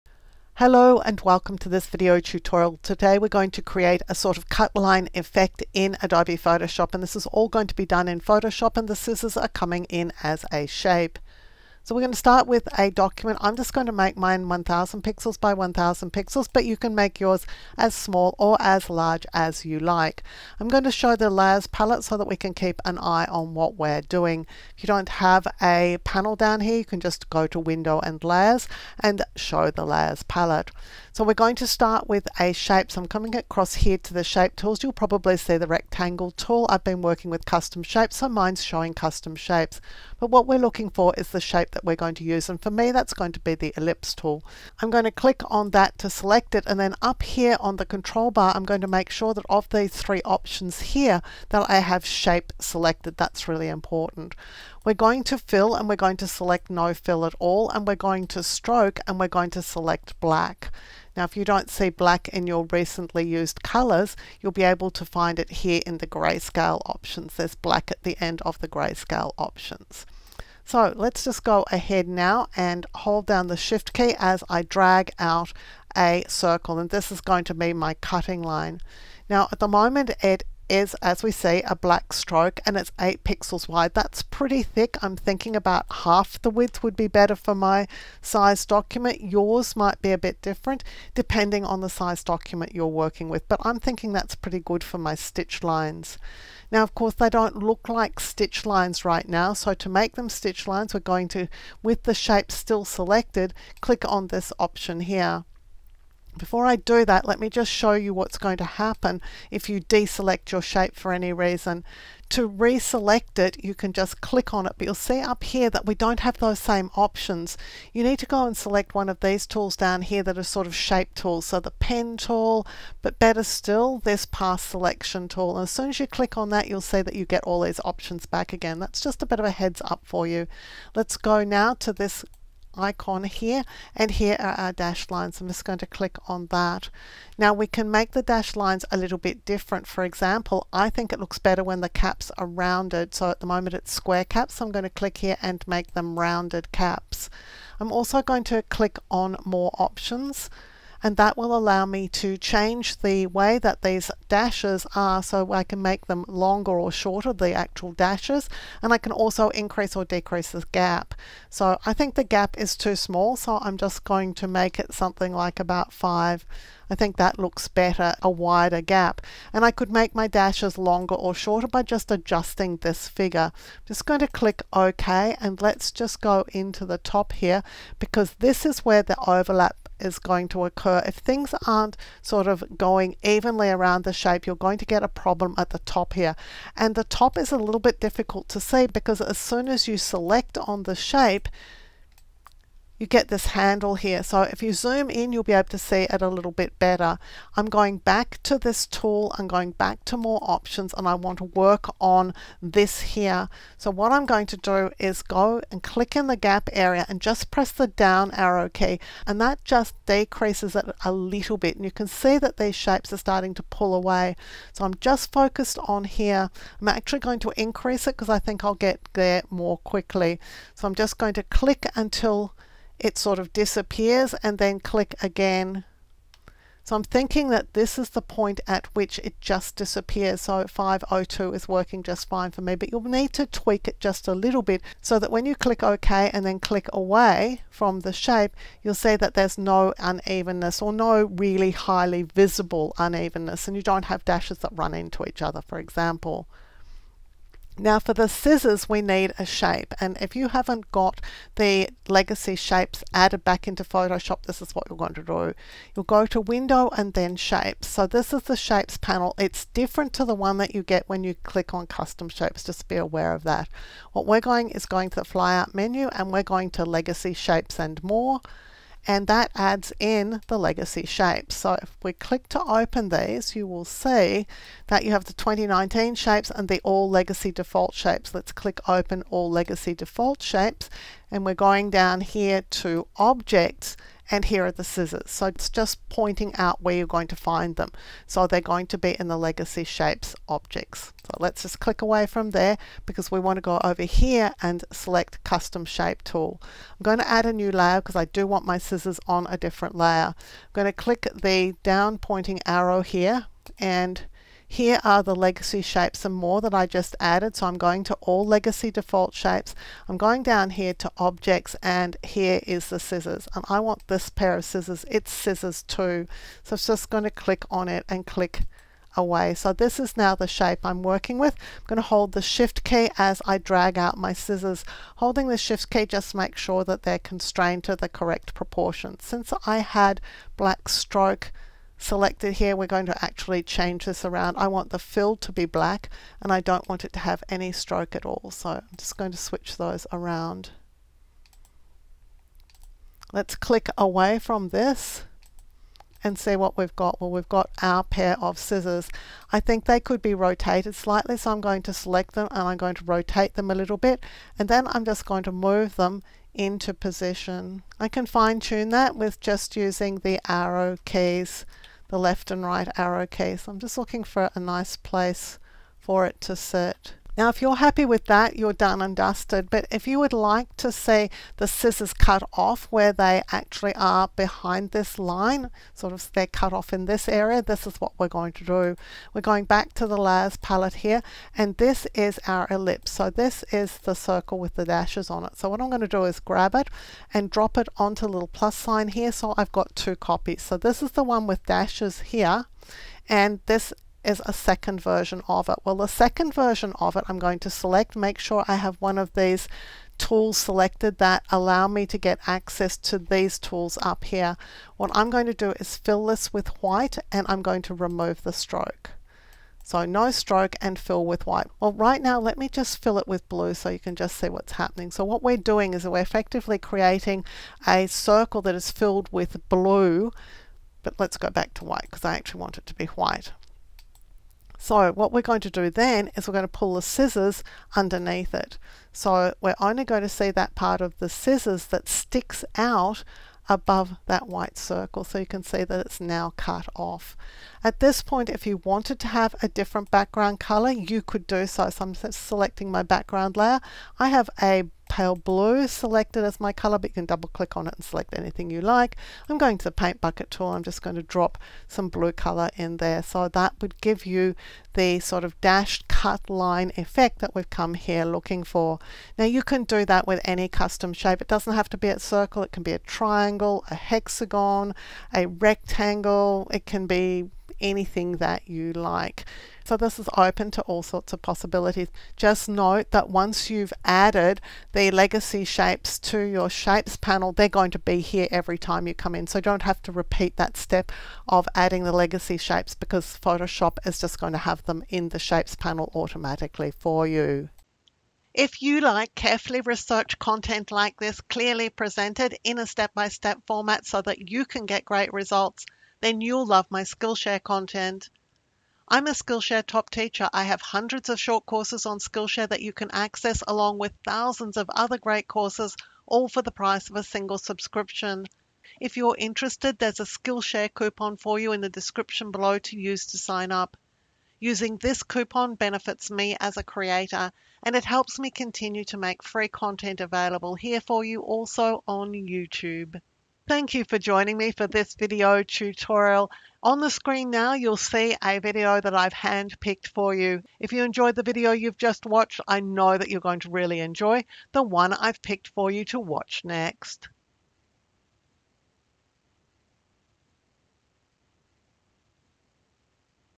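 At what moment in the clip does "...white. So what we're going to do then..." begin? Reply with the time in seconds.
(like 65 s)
423 s.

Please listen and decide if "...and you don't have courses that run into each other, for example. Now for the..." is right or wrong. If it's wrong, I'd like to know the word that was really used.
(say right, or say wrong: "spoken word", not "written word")
wrong: "dashes", not "courses".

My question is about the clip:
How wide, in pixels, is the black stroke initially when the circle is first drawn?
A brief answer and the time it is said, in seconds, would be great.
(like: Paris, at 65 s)
8, at 82 s.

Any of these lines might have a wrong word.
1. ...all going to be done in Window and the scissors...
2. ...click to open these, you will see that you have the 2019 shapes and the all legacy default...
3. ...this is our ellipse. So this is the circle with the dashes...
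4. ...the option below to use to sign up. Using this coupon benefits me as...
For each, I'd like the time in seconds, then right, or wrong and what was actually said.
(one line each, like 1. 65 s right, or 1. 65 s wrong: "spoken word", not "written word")
1. 7 s wrong: "Photoshop", not "Window"
2. 272 s right
3. 381 s right
4. 511 s wrong: "description", not "option".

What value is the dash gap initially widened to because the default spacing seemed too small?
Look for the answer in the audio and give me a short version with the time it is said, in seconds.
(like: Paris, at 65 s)
5, at 165 s.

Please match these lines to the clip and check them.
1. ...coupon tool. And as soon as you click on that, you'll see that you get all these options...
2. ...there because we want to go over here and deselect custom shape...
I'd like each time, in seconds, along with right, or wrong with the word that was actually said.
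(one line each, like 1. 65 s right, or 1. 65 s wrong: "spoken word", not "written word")
1. 124 s wrong: "selection", not "coupon"
2. 292 s wrong: "select", not "deselect".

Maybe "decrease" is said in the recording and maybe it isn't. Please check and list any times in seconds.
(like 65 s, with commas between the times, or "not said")
160 s, 210 s.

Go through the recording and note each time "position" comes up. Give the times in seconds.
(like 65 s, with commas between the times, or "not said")
356 s.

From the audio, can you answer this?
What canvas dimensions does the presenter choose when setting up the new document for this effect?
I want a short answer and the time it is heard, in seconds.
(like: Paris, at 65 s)
1000 by 1000 pixels, at 14 s.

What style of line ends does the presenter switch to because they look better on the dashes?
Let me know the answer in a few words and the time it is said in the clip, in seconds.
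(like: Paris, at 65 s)
rounded caps, at 146 s.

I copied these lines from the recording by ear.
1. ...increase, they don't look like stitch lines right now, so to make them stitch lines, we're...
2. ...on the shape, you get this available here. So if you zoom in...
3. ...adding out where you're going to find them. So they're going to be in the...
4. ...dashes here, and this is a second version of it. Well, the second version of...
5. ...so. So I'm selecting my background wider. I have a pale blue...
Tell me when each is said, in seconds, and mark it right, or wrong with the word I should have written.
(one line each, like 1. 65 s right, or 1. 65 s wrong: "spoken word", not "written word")
1. 96 s wrong: "course", not "increase"
2. 190 s wrong: "handle", not "available"
3. 286 s wrong: "pointing", not "adding"
4. 391 s right
5. 441 s wrong: "layer", not "wider".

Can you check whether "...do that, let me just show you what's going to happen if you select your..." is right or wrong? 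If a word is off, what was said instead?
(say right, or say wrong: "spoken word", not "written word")
wrong: "deselect", not "select".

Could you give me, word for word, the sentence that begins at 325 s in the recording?
Holding the shift key just make sure that they're constrained to the correct proportion.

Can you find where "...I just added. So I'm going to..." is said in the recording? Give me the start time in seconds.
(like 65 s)
306 s.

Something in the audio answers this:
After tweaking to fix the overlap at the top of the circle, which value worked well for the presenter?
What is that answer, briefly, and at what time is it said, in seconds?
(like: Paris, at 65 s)
502, at 230 s.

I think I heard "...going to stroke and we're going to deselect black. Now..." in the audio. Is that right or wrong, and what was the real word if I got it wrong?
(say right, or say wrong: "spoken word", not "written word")
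wrong: "select", not "deselect".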